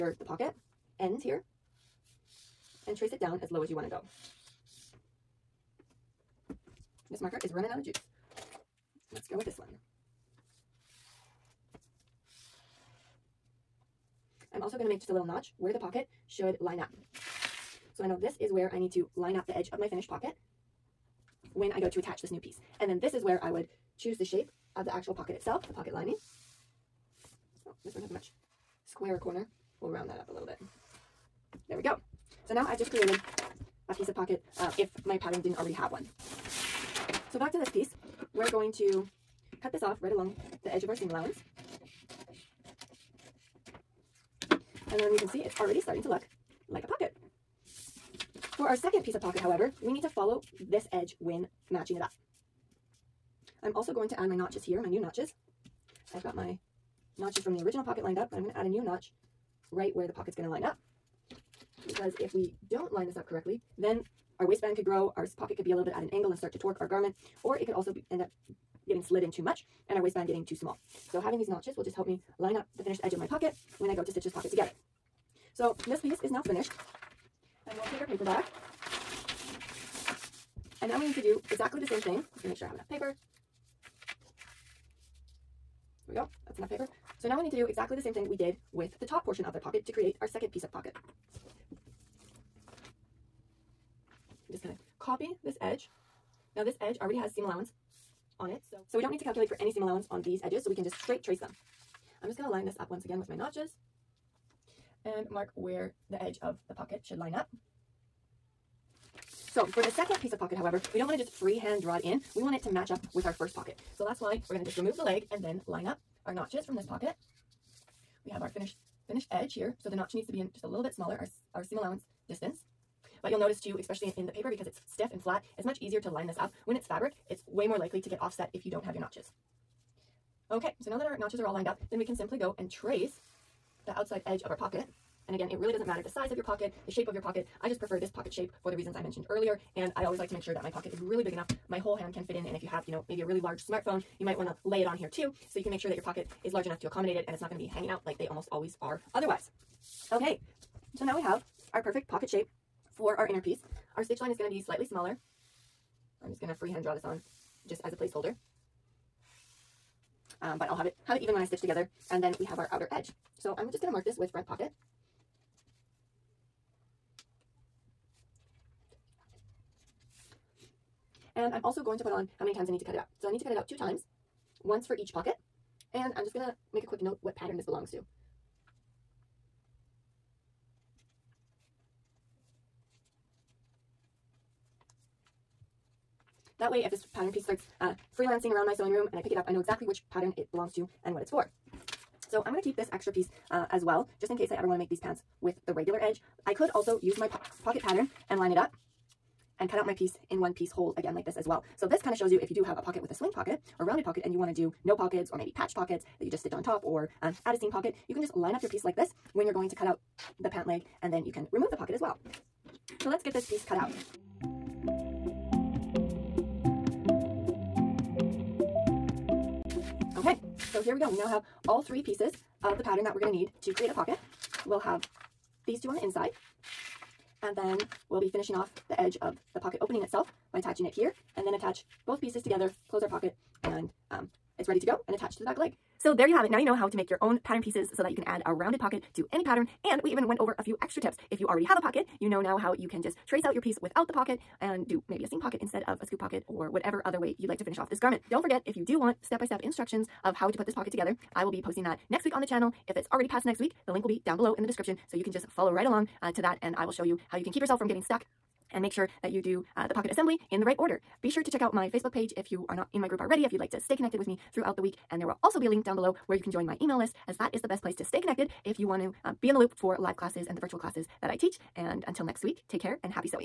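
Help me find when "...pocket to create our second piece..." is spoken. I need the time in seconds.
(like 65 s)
89 s.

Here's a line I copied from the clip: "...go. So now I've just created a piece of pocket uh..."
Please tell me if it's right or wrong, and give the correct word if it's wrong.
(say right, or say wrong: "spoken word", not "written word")
right.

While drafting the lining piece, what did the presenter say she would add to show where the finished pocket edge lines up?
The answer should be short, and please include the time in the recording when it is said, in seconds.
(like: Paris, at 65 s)
a little notch, at 15 s.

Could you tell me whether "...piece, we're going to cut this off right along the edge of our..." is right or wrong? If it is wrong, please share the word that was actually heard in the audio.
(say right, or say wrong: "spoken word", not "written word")
right.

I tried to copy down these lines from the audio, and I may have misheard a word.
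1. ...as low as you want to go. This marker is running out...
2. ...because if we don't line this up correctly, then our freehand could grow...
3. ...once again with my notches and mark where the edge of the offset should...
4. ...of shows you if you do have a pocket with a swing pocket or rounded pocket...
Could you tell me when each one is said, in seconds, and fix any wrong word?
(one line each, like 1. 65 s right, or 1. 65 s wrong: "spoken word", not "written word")
1. 3 s right
2. 61 s wrong: "waistband", not "freehand"
3. 102 s wrong: "pocket", not "offset"
4. 202 s right.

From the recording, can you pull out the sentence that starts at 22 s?
And then this is where I would choose the shape of the actual pocket itself, the pocket lining.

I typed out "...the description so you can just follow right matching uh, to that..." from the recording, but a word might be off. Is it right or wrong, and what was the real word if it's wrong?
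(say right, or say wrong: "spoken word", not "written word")
wrong: "along", not "matching".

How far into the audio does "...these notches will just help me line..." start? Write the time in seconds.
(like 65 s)
71 s.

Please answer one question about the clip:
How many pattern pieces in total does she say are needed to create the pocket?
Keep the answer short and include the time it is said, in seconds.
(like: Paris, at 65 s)
3, at 221 s.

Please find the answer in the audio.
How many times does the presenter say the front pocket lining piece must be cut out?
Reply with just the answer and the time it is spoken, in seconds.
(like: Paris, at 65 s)
2, at 173 s.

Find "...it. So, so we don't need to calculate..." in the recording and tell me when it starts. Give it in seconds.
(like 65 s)
98 s.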